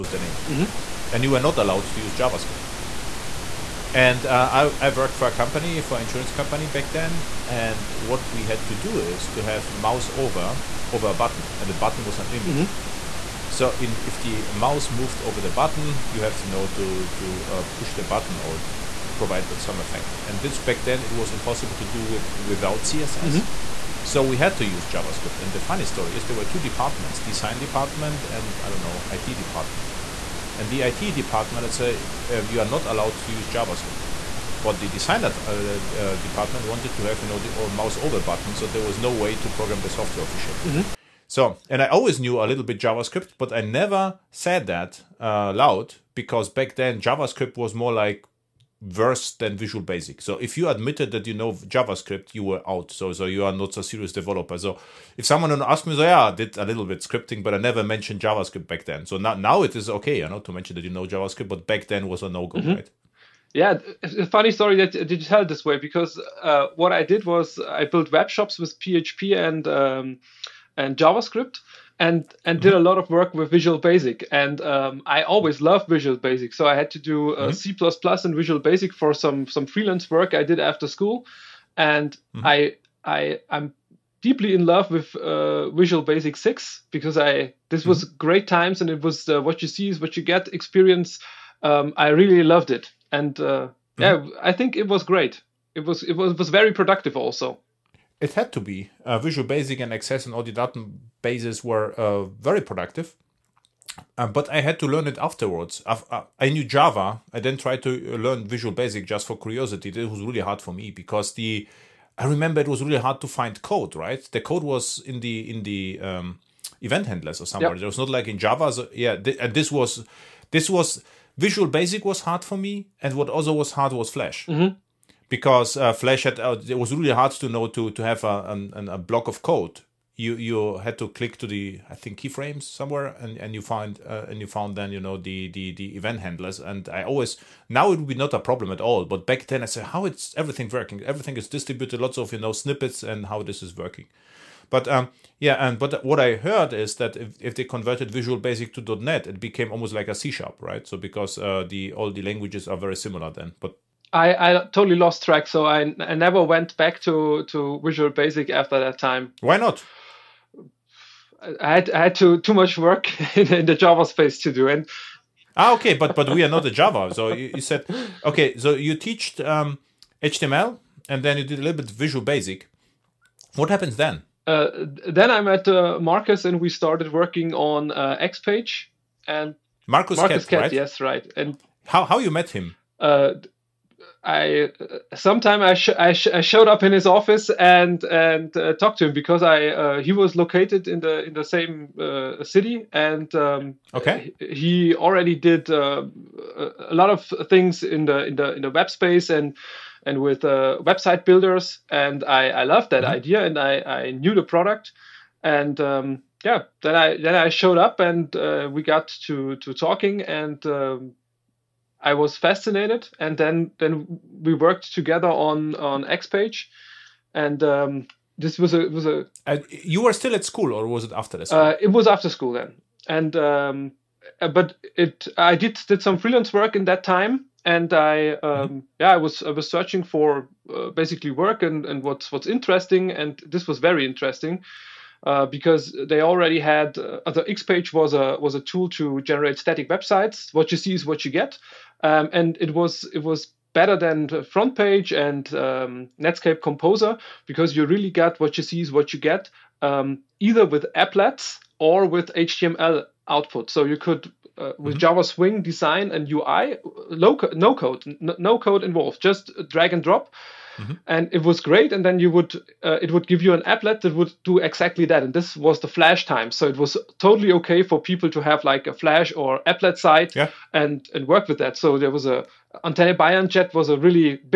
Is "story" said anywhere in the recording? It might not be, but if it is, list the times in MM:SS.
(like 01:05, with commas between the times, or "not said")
00:25, 01:04.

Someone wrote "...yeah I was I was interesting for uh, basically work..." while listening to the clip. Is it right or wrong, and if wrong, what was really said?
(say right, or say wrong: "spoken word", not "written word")
wrong: "searching", not "interesting".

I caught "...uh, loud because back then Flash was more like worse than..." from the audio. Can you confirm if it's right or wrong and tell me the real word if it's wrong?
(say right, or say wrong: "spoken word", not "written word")
wrong: "JavaScript", not "Flash".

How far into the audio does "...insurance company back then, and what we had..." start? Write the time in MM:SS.
00:06.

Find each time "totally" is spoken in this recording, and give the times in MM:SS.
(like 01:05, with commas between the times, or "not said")
02:34, 04:27.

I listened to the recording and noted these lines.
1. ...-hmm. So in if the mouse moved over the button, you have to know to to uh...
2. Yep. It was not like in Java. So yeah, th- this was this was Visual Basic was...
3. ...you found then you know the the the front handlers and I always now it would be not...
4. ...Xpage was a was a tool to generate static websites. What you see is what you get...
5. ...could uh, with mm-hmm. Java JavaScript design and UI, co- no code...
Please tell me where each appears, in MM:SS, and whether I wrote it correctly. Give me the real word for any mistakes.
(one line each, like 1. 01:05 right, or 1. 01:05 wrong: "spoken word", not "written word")
1. 00:12 right
2. 01:57 right
3. 02:14 wrong: "event", not "front"
4. 03:57 right
5. 04:13 wrong: "Swing", not "JavaScript".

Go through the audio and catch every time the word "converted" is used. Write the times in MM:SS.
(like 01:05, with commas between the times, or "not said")
02:27.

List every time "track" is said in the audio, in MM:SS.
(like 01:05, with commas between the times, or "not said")
02:35.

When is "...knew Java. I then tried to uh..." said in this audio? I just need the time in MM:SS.
01:46.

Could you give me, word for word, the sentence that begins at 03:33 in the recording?
And then then we worked together on on XPage, and.